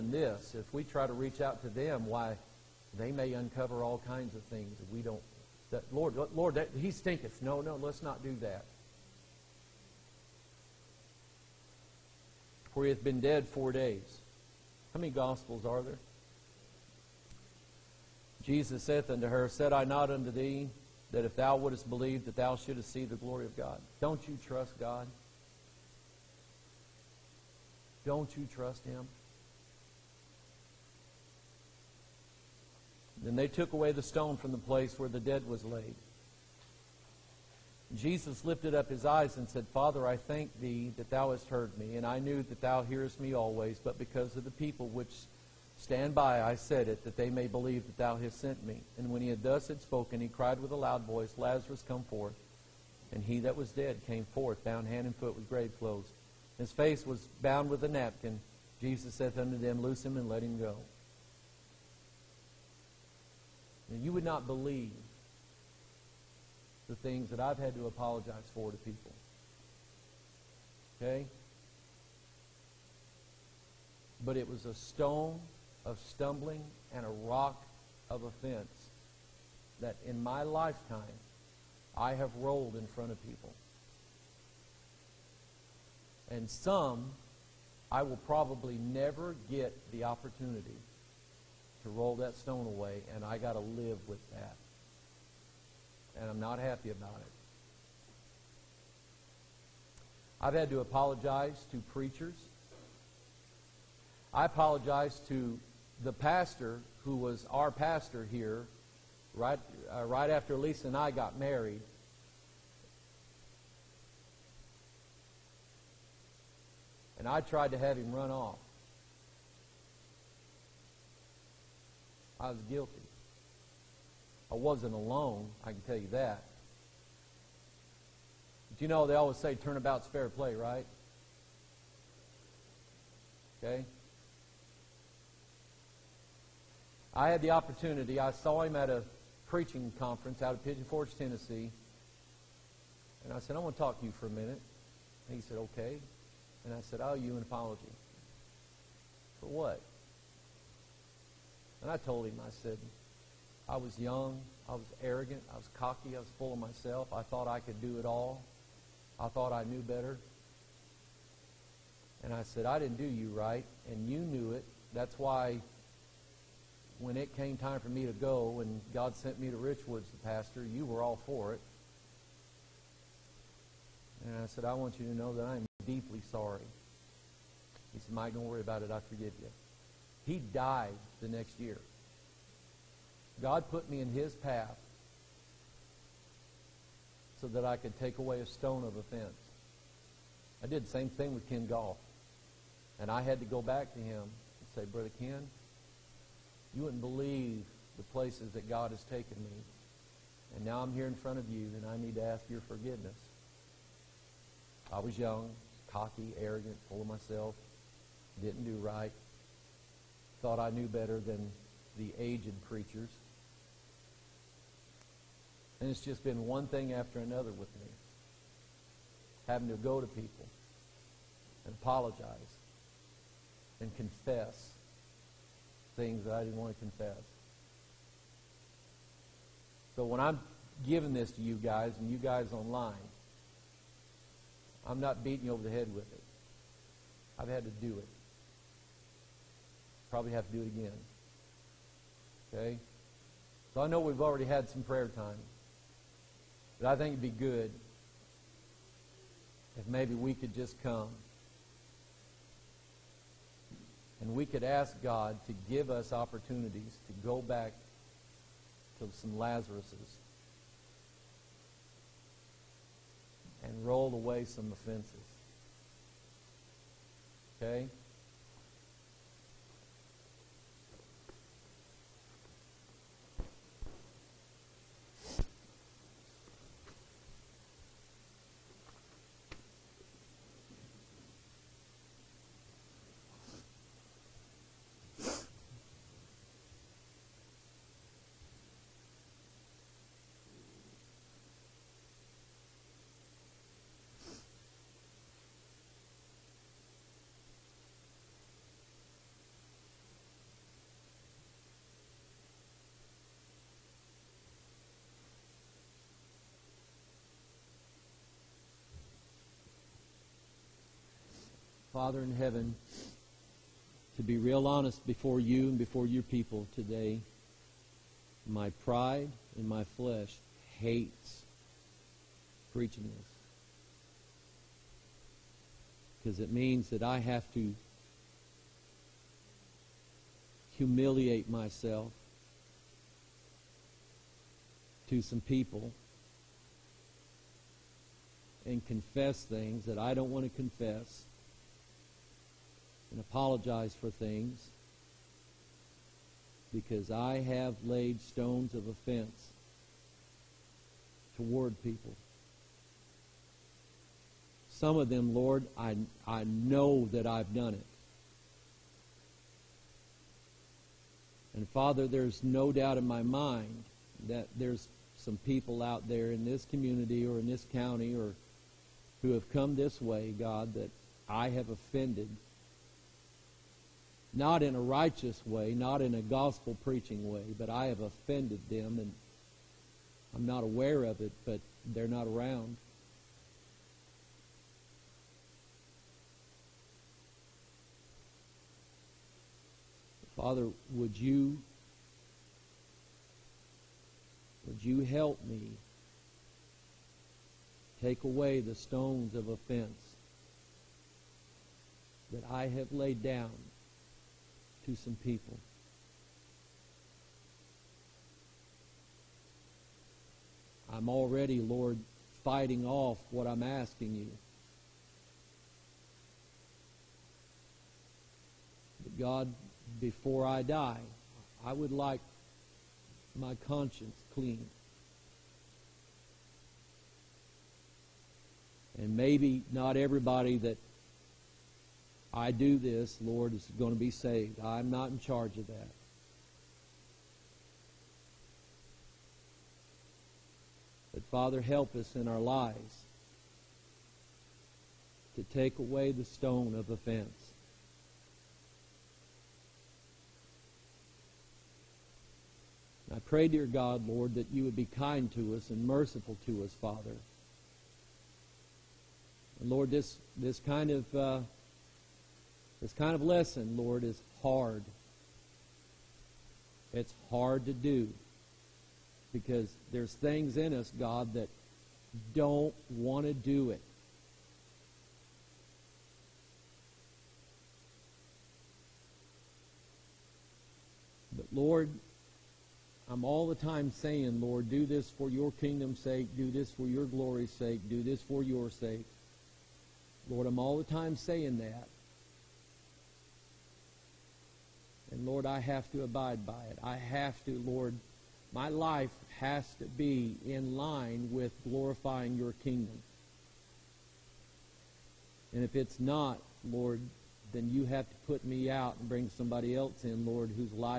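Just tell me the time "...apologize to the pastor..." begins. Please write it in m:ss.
1:44.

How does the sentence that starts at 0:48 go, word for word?
And when he had thus had spoken, he cried with a loud voice, Lazarus, come forth.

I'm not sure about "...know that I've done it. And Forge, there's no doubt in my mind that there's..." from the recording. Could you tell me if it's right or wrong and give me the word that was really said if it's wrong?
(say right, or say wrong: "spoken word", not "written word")
wrong: "Father", not "Forge".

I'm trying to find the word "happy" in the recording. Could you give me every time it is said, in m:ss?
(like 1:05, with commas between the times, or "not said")
1:36.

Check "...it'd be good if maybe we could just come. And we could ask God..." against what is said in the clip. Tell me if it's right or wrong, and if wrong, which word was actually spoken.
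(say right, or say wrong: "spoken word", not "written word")
right.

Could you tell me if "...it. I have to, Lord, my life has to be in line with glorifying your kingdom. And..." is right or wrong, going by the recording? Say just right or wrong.
right.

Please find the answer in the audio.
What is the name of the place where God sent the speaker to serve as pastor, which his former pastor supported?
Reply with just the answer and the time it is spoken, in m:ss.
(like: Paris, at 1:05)
Richwoods, at 2:49.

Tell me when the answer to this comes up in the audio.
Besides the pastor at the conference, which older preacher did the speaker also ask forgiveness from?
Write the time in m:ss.
3:11.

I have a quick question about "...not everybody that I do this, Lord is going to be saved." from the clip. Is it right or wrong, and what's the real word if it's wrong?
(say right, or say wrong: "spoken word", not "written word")
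right.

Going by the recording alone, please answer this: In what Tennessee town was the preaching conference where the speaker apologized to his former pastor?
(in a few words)
Pigeon Forge.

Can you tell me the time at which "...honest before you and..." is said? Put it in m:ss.
5:14.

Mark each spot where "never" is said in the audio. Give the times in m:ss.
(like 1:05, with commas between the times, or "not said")
1:28.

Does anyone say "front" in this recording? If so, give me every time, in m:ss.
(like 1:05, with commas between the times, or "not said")
1:22, 3:21.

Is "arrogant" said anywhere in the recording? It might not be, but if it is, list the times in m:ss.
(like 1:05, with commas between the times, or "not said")
2:35, 3:26.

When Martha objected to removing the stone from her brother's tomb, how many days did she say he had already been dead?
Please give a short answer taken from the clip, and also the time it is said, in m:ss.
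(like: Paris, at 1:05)
4, at 0:13.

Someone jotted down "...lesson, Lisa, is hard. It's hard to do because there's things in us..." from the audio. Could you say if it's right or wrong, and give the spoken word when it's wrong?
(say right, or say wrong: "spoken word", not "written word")
wrong: "Lord", not "Lisa".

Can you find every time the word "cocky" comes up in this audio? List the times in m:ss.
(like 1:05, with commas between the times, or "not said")
2:35, 3:25.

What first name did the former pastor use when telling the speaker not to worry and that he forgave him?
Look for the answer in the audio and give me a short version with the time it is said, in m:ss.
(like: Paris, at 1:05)
Mike, at 2:58.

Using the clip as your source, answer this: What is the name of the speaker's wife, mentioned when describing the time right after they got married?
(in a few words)
Lisa.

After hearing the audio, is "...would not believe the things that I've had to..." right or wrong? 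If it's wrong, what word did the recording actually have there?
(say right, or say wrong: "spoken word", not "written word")
right.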